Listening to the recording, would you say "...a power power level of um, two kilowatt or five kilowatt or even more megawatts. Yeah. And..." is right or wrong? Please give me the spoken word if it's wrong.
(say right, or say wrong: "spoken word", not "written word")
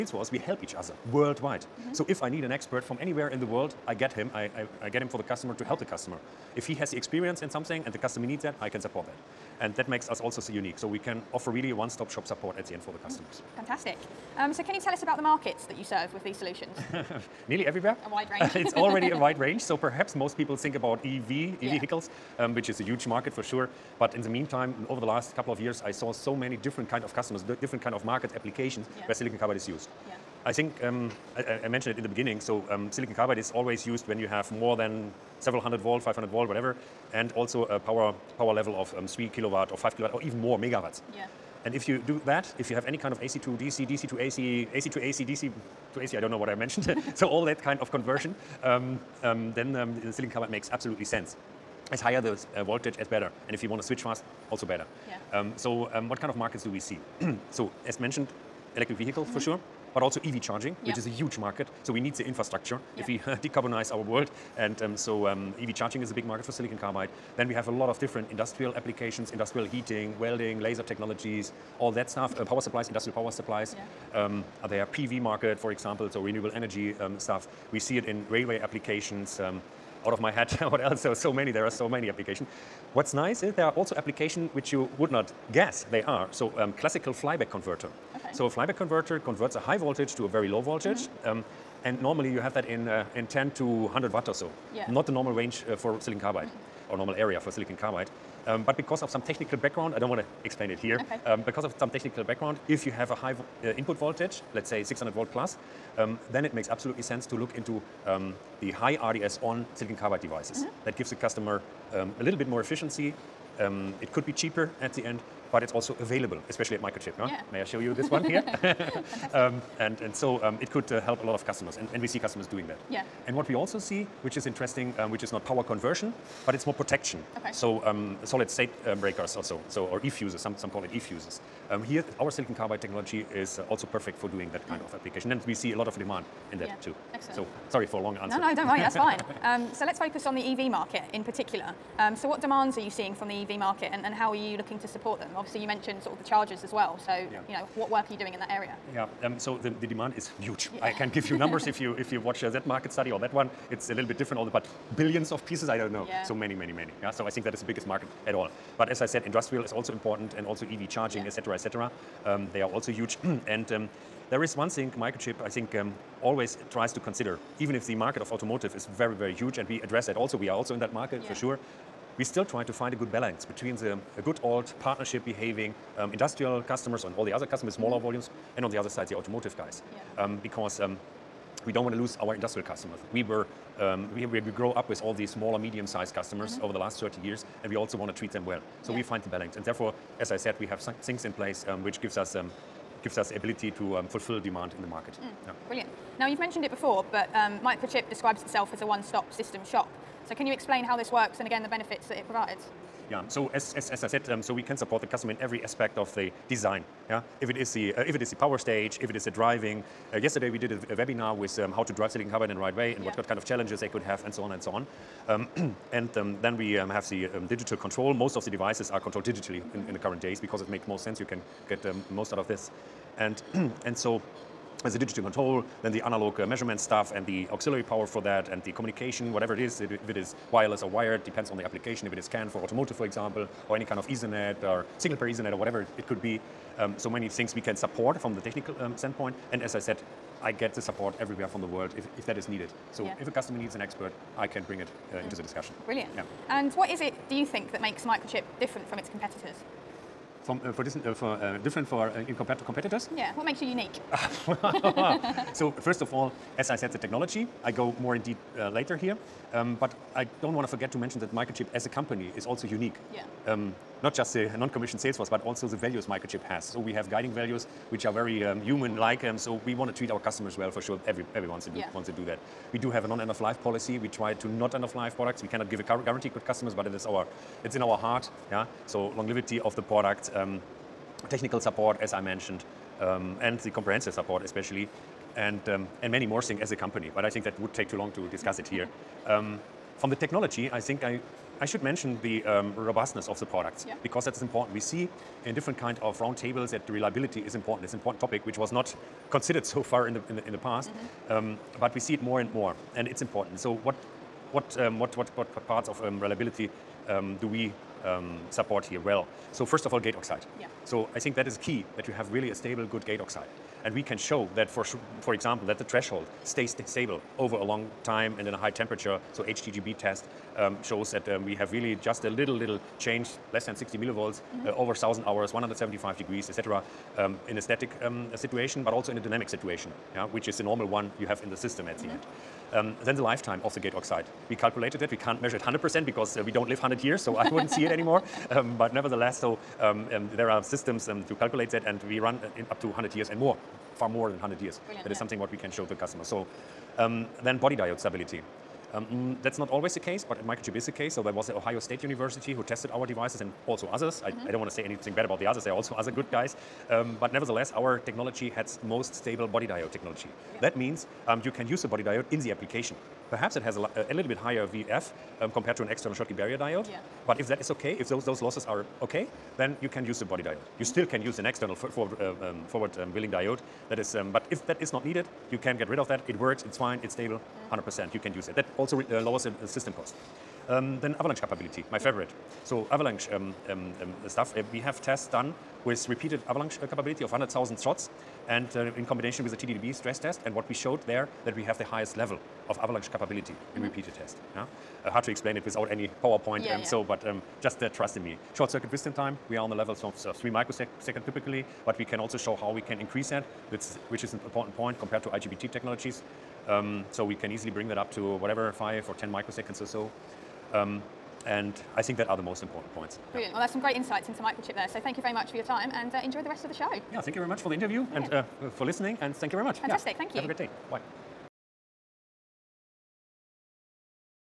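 wrong: "three", not "two".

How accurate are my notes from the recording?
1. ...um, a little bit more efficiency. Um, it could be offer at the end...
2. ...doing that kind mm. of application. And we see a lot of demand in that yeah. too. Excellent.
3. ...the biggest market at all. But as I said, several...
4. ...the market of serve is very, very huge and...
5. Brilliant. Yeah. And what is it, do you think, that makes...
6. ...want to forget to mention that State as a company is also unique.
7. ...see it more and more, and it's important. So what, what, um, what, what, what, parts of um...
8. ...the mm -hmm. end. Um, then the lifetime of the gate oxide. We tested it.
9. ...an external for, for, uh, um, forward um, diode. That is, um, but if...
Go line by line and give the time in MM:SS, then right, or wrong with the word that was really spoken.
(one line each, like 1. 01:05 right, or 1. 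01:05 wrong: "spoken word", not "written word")
1. 01:51 wrong: "cheaper", not "offer"
2. 02:14 right
3. 02:37 wrong: "industrial", not "several"
4. 02:47 wrong: "automotive", not "serve"
5. 04:05 right
6. 04:20 wrong: "Microchip", not "State"
7. 05:01 right
8. 05:31 wrong: "calculated", not "tested"
9. 06:11 right.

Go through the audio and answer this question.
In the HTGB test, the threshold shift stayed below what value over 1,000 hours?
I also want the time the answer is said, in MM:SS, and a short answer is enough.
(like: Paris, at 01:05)
60 millivolts, at 05:23.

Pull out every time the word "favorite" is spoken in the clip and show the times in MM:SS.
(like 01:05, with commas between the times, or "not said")
06:21.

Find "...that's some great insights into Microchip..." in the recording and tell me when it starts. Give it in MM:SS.
06:53.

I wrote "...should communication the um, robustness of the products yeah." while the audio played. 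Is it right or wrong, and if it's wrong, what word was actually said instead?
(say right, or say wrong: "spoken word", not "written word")
wrong: "mention", not "communication".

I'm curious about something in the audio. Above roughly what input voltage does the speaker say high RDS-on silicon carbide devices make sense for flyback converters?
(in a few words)
600 volt.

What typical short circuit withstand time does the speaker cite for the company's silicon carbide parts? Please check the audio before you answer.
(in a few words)
3 microseconds.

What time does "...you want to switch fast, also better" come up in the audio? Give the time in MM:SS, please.
00:53.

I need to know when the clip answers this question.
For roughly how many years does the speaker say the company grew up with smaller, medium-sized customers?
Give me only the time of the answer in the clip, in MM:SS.
03:07.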